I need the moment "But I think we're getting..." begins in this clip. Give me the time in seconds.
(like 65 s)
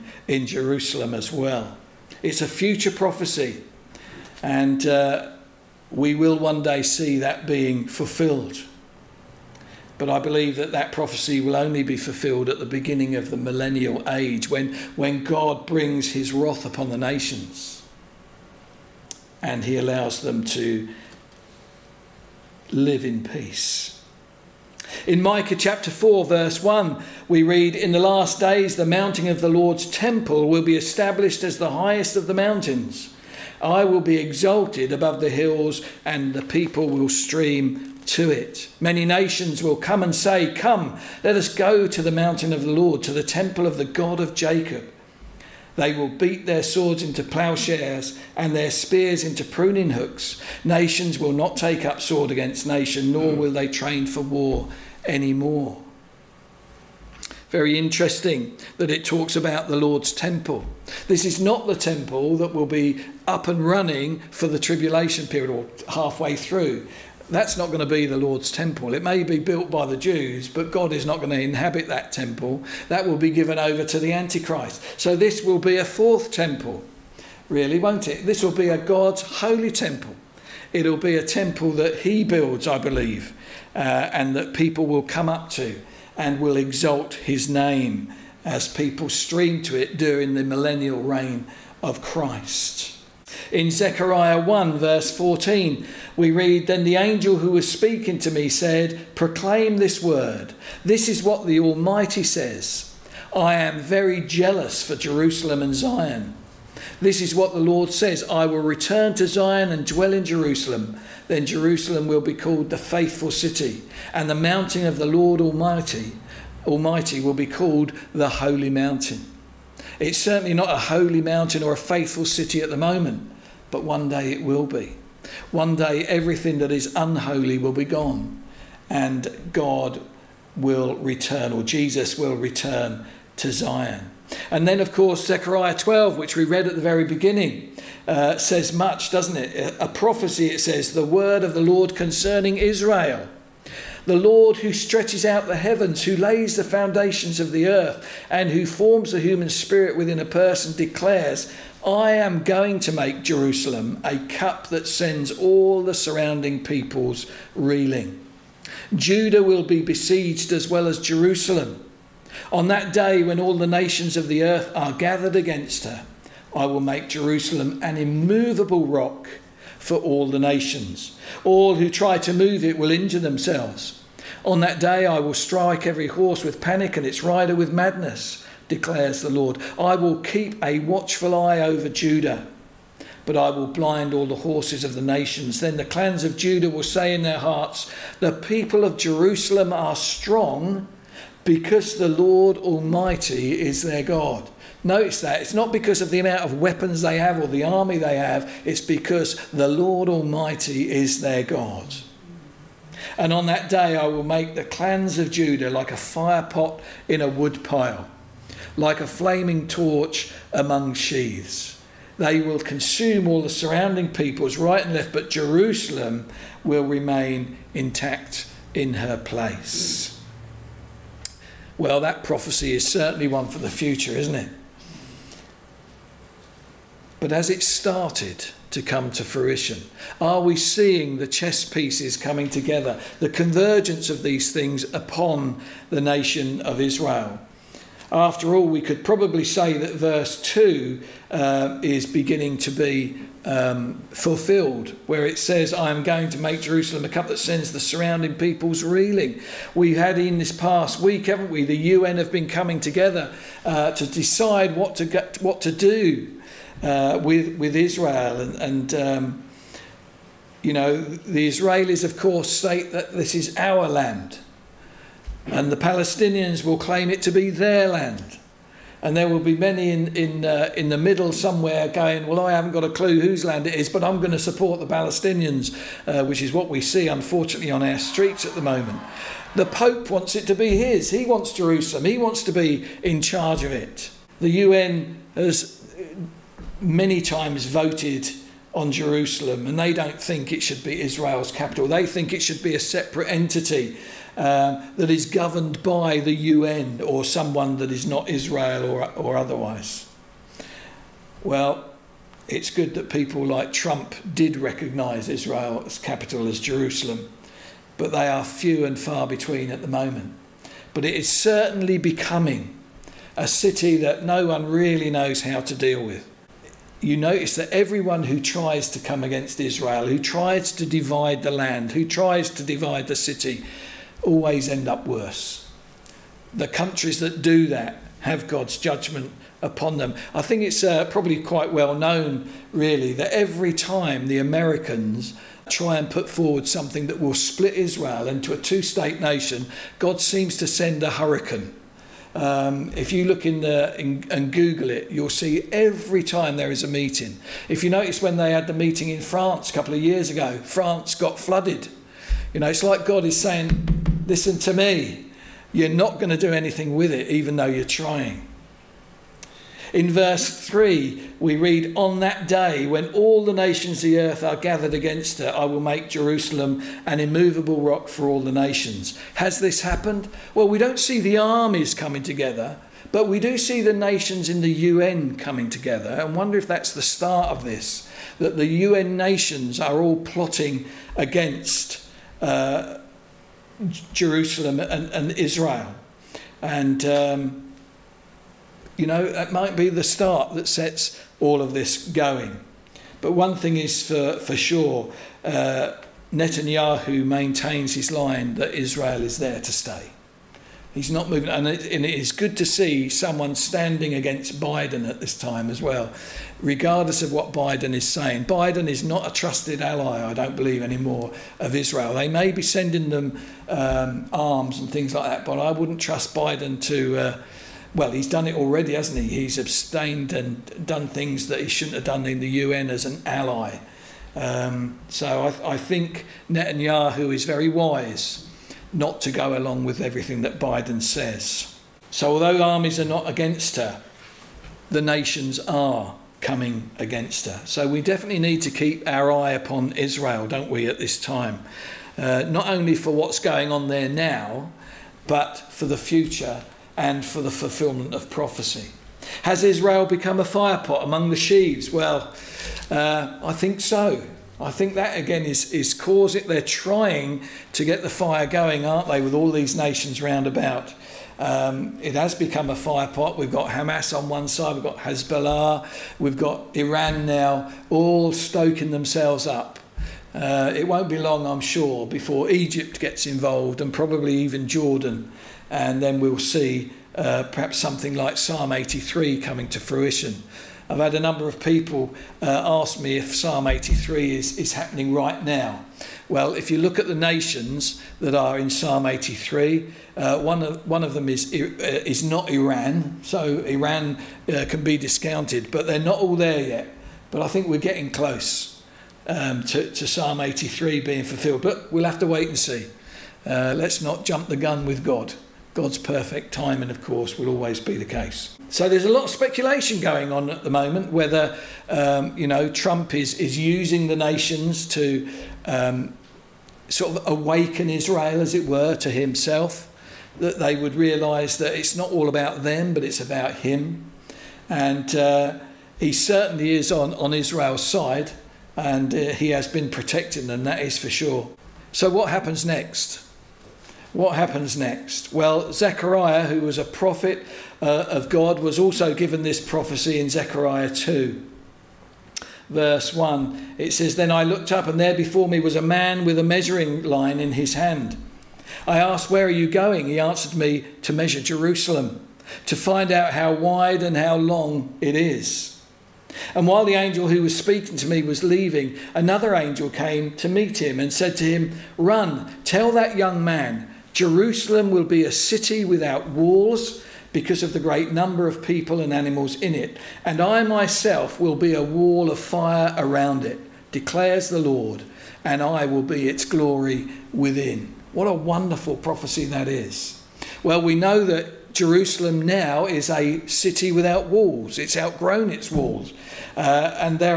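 497 s.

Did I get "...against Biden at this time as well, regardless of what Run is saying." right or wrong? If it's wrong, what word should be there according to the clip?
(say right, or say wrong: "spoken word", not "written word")
wrong: "Biden", not "Run".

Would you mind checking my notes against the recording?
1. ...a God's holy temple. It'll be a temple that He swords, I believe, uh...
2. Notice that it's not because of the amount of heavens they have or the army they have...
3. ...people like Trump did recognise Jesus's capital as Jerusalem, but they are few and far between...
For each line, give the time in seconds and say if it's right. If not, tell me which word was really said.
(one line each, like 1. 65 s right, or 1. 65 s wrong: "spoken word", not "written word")
1. 78 s wrong: "builds", not "swords"
2. 194 s wrong: "weapons", not "heavens"
3. 303 s wrong: "Israel", not "Jesus".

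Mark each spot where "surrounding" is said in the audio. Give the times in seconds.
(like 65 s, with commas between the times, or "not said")
155 s, 213 s, 247 s.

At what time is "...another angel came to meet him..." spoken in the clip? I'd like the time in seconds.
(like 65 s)
559 s.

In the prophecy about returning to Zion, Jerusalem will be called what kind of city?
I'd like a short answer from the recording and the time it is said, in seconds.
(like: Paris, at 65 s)
the faithful city, at 112 s.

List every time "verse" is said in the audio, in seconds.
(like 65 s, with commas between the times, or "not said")
26 s, 94 s, 239 s, 360 s, 542 s.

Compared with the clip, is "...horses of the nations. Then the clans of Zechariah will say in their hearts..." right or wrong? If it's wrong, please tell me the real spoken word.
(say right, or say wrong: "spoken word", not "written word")
wrong: "Judah", not "Zechariah".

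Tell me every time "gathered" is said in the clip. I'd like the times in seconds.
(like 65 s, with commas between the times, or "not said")
164 s, 364 s.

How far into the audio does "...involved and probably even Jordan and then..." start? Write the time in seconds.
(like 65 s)
473 s.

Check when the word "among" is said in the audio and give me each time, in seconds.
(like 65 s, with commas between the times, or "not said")
210 s, 451 s.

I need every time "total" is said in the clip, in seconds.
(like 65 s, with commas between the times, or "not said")
not said.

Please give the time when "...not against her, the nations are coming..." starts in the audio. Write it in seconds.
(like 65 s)
433 s.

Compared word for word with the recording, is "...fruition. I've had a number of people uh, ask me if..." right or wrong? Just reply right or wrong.
right.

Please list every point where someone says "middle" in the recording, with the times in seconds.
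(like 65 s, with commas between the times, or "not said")
270 s.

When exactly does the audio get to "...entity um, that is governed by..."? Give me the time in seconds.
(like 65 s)
293 s.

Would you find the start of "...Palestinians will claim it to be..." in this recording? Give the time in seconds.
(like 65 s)
265 s.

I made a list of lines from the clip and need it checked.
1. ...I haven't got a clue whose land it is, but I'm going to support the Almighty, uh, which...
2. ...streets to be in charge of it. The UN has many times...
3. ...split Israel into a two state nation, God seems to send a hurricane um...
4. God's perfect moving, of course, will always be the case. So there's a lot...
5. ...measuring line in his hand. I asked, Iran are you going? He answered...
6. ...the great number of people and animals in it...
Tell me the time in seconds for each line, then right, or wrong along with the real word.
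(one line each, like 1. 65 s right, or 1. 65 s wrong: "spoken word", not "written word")
1. 272 s wrong: "Palestinians", not "Almighty"
2. 282 s wrong: "wants", not "streets"
3. 337 s right
4. 505 s wrong: "timing", not "moving"
5. 546 s wrong: "Where", not "Iran"
6. 567 s right.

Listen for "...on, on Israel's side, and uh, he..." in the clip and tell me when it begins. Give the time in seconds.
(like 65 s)
526 s.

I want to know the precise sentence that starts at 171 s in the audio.
All who try to move it will injure themselves.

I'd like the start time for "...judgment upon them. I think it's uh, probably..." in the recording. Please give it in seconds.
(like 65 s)
328 s.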